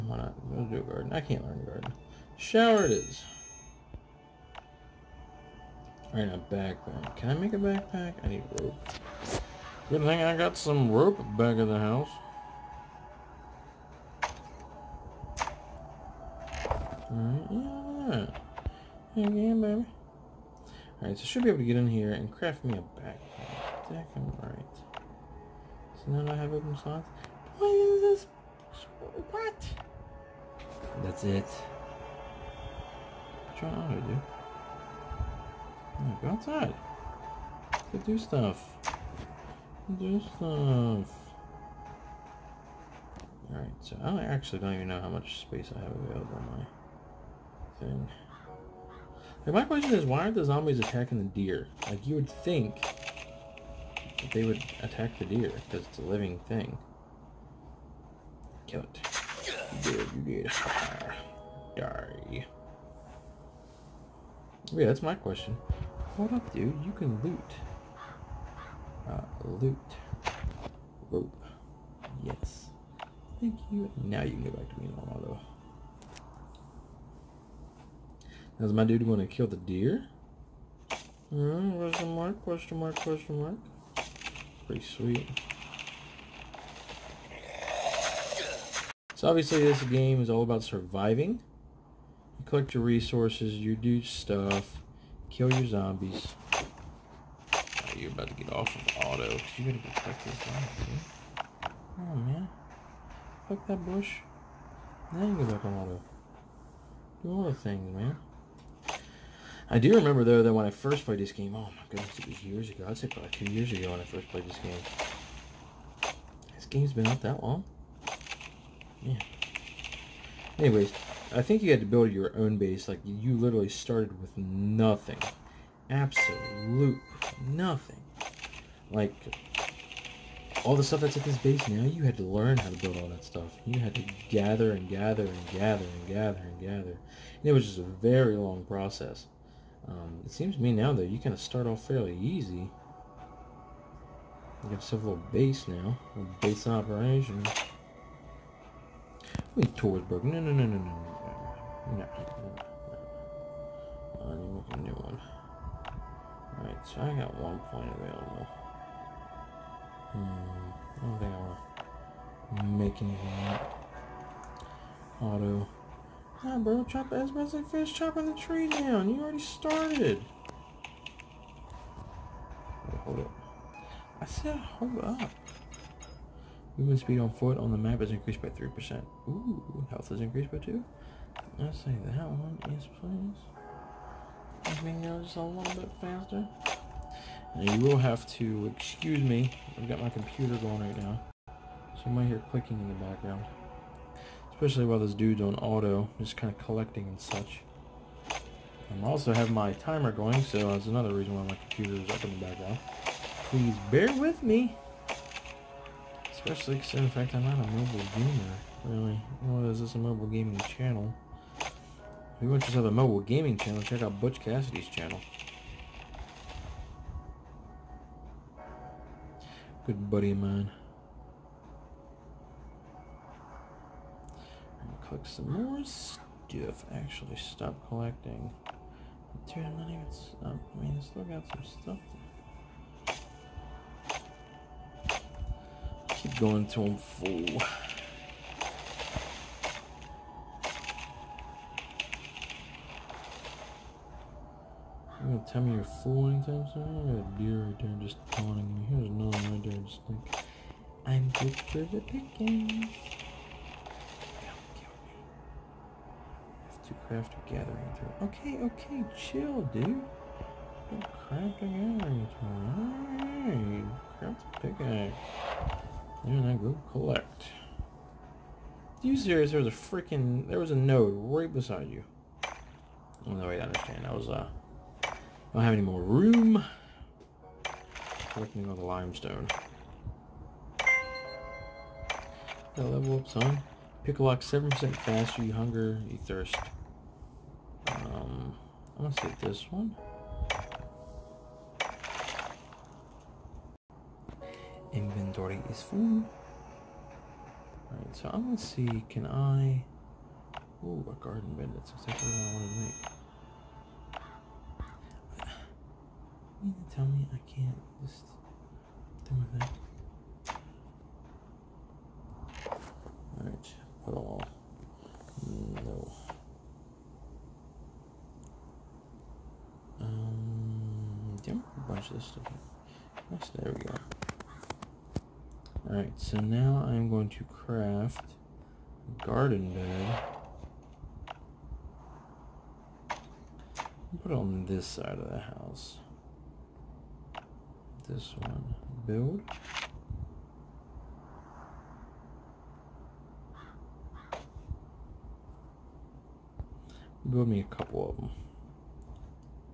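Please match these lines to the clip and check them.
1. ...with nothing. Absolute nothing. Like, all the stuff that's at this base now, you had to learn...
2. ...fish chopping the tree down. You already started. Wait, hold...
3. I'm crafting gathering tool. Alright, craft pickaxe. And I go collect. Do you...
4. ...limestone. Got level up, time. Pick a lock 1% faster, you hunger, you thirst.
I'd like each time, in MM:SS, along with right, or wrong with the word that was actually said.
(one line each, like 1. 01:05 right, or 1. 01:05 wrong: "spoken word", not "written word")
1. 02:04 right
2. 02:47 right
3. 04:20 right
4. 04:38 wrong: "7", not "1".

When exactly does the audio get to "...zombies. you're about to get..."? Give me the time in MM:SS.
01:35.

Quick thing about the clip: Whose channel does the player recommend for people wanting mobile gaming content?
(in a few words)
Butch Cassidy.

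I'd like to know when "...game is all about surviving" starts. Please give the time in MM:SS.
01:29.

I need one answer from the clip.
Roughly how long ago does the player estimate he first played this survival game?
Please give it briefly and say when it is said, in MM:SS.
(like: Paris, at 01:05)
2 years, at 01:53.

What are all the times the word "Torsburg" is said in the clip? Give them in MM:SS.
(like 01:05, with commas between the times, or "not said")
02:29.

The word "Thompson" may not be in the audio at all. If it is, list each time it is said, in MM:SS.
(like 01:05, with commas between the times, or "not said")
04:06.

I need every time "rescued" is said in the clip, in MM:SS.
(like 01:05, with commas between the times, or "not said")
not said.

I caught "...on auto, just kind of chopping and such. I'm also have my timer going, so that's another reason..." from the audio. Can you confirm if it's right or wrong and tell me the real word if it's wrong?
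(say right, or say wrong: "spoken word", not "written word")
wrong: "collecting", not "chopping".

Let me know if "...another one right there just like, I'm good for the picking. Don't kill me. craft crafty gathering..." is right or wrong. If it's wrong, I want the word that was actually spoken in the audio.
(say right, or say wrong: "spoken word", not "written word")
right.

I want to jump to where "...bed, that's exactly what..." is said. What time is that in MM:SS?
05:01.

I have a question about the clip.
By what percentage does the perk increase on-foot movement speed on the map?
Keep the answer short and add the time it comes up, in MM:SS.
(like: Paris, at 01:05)
3%, at 02:58.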